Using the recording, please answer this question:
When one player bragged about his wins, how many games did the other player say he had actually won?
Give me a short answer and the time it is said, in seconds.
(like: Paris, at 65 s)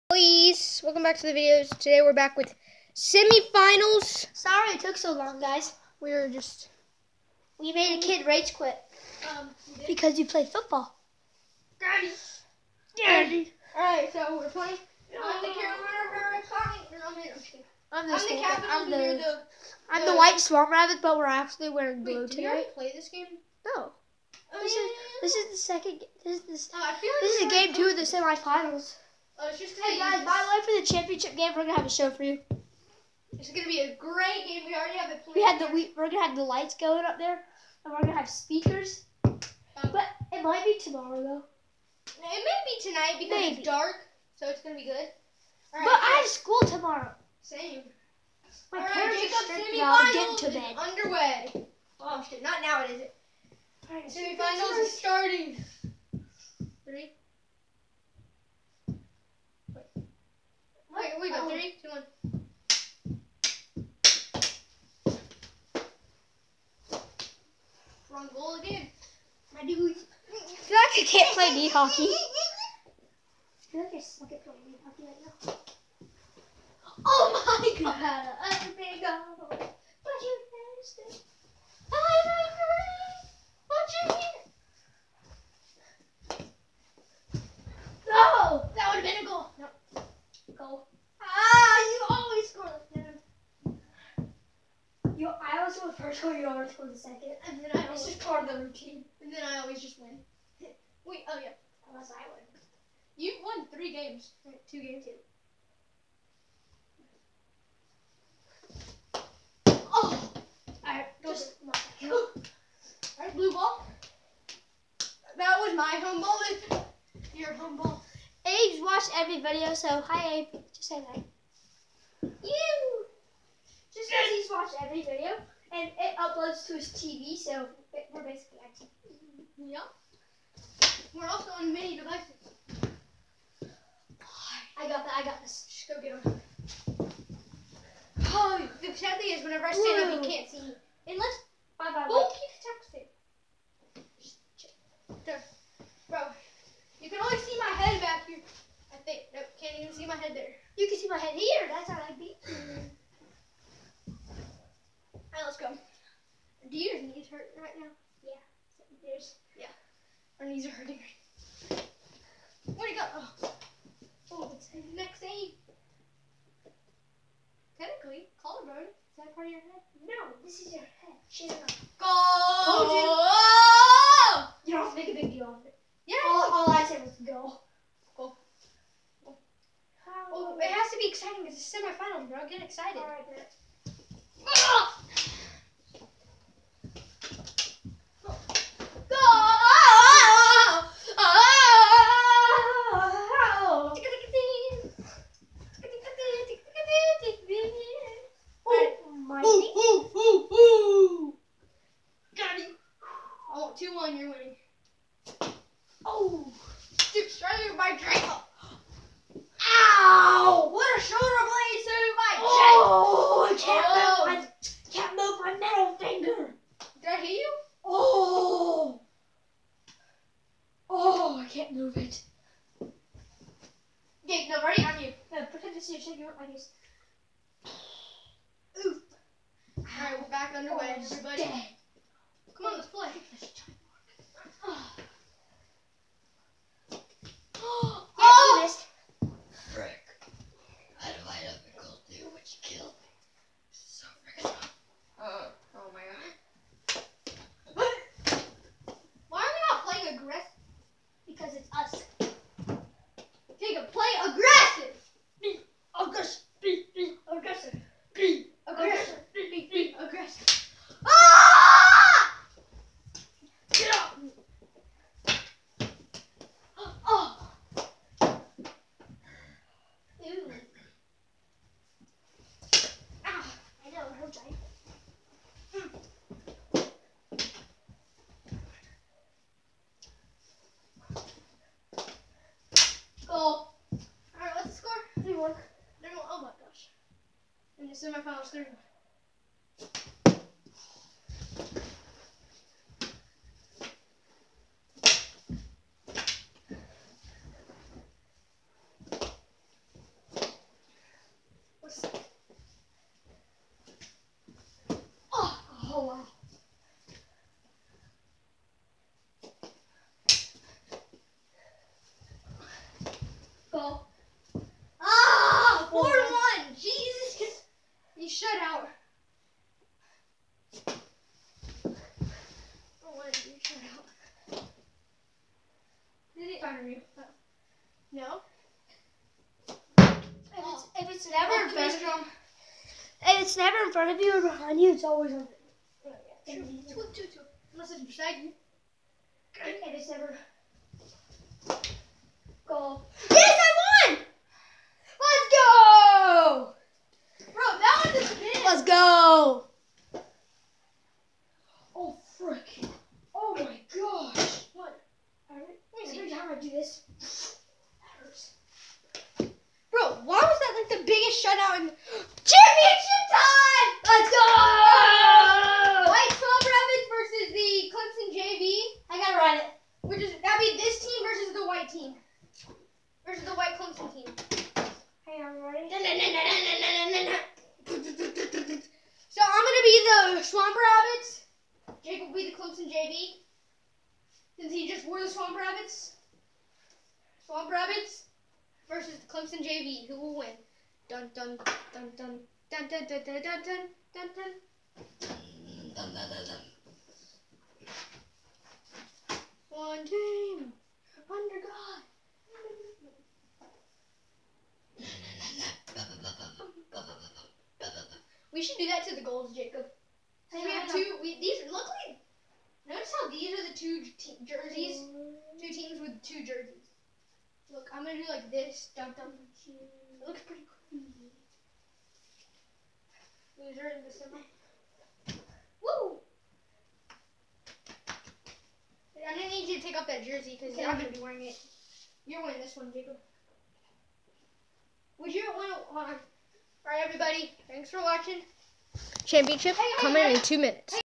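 2, at 104 s.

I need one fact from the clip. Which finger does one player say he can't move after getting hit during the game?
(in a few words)
Middle finger.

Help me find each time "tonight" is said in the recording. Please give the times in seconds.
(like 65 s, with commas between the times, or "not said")
22 s, 42 s.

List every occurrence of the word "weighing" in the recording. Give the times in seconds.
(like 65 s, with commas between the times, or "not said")
not said.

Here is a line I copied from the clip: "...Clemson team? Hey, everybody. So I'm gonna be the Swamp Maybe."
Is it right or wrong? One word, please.
wrong.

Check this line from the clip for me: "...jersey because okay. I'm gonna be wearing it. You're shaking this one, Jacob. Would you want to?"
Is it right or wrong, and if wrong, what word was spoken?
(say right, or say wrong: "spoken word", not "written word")
wrong: "wearing", not "shaking".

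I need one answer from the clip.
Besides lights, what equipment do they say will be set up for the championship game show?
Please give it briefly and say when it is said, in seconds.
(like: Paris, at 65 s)
Speakers, at 38 s.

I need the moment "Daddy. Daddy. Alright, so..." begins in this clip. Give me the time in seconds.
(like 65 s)
11 s.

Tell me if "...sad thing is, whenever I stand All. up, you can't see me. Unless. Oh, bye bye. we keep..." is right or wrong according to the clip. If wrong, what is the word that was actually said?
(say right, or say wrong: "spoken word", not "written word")
wrong: "Whoa", not "All".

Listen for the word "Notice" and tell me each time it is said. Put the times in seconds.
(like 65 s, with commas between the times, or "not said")
412 s.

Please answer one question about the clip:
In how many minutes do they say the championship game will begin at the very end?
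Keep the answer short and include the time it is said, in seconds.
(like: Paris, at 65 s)
2, at 440 s.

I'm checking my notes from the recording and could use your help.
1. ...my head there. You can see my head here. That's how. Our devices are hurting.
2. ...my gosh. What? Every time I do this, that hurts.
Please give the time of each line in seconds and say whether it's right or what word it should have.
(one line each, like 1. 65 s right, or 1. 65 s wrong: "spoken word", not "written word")
1. 150 s wrong: "knees", not "devices"
2. 353 s right.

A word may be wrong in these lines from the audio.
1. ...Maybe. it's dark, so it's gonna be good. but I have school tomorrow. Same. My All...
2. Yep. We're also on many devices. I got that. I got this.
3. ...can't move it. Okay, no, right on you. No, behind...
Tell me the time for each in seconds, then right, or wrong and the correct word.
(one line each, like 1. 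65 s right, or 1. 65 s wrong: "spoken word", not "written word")
1. 43 s right
2. 129 s right
3. 221 s wrong: "pretend", not "behind".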